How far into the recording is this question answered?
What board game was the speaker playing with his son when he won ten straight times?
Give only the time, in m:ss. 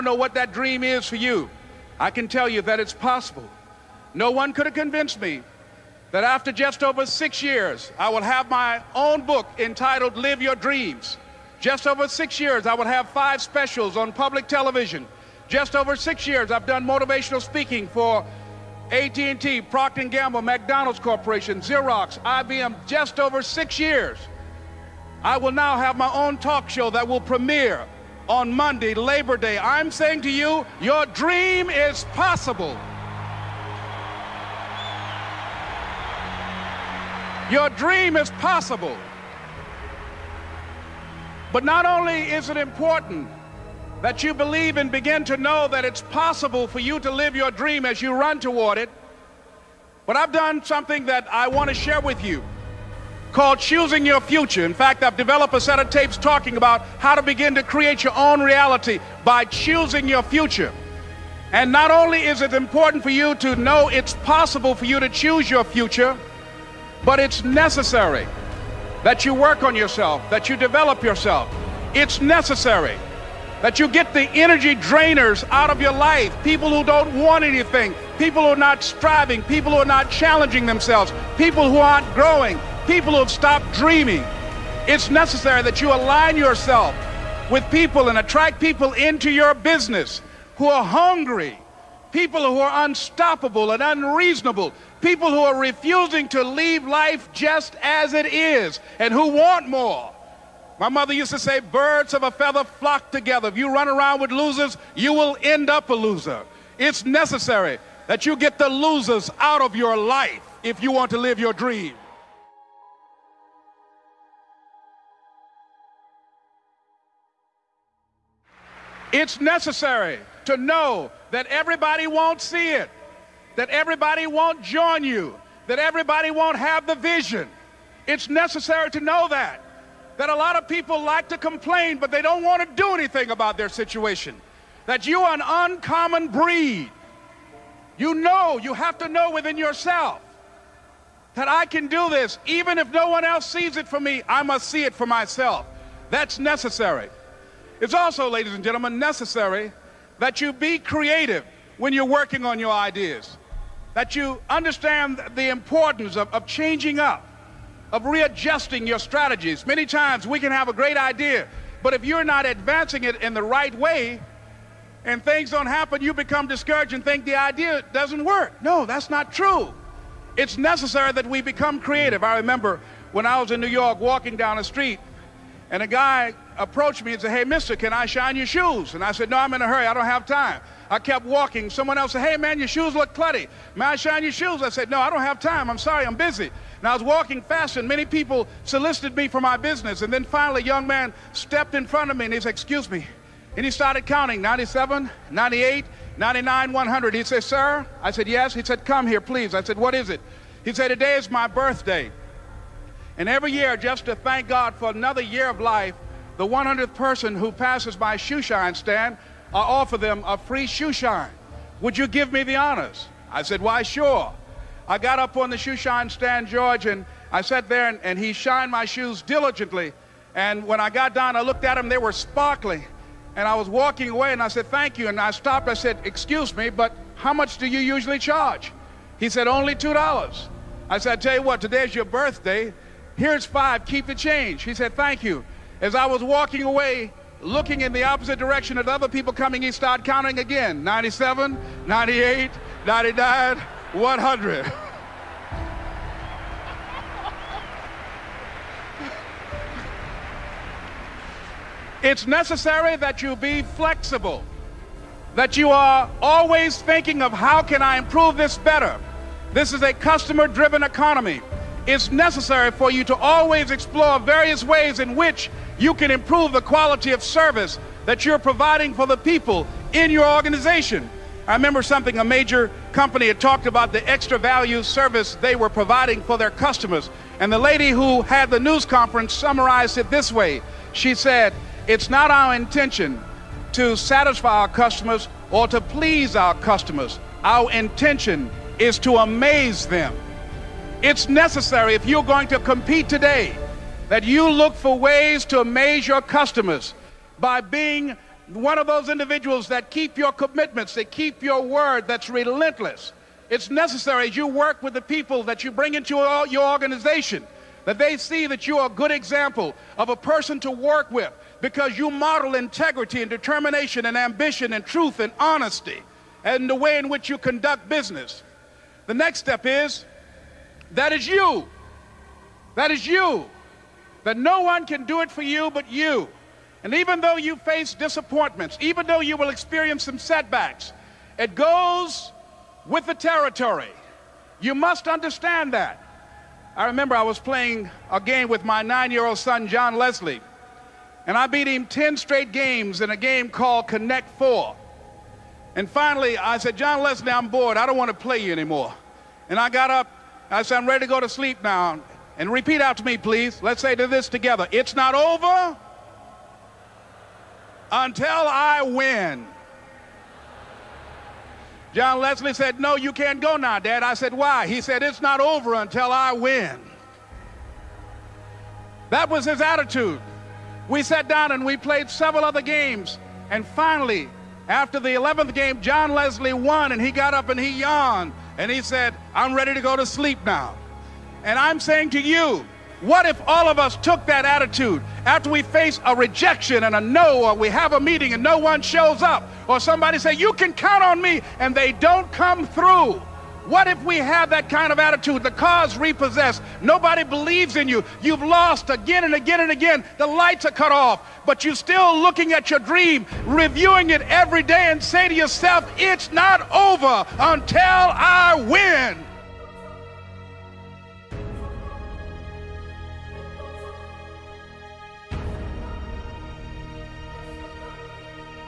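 5:43.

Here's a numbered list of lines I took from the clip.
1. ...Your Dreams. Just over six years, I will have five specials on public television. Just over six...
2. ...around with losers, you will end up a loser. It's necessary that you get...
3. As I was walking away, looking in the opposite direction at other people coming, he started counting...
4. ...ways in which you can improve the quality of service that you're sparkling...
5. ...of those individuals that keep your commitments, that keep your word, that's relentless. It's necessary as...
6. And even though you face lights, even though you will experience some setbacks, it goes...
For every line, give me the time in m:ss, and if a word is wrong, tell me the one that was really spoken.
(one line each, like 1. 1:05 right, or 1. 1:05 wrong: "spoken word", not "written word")
1. 0:10 right
2. 1:43 right
3. 3:55 right
4. 4:24 wrong: "providing", not "sparkling"
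5. 4:58 right
6. 5:26 wrong: "disappointments", not "lights".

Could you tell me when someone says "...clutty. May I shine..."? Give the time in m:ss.
3:03.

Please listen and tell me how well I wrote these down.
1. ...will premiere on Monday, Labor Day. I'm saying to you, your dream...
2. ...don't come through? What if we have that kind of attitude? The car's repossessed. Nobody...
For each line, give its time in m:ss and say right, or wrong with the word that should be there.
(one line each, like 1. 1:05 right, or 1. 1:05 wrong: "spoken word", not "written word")
1. 0:27 right
2. 6:31 right.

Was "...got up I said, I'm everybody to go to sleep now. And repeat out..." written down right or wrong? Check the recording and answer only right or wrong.
wrong.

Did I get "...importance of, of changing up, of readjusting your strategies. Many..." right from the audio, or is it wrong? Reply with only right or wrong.
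right.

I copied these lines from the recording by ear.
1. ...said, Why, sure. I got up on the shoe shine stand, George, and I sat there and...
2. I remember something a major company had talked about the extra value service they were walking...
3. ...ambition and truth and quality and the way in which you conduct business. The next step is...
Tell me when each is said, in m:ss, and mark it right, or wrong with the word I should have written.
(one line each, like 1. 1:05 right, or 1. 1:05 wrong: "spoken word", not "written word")
1. 3:33 right
2. 4:31 wrong: "providing", not "walking"
3. 5:14 wrong: "honesty", not "quality".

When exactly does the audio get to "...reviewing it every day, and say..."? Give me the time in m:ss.
6:43.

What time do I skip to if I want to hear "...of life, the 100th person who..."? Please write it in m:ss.
3:25.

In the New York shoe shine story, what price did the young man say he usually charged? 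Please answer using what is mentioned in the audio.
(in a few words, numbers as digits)
$2.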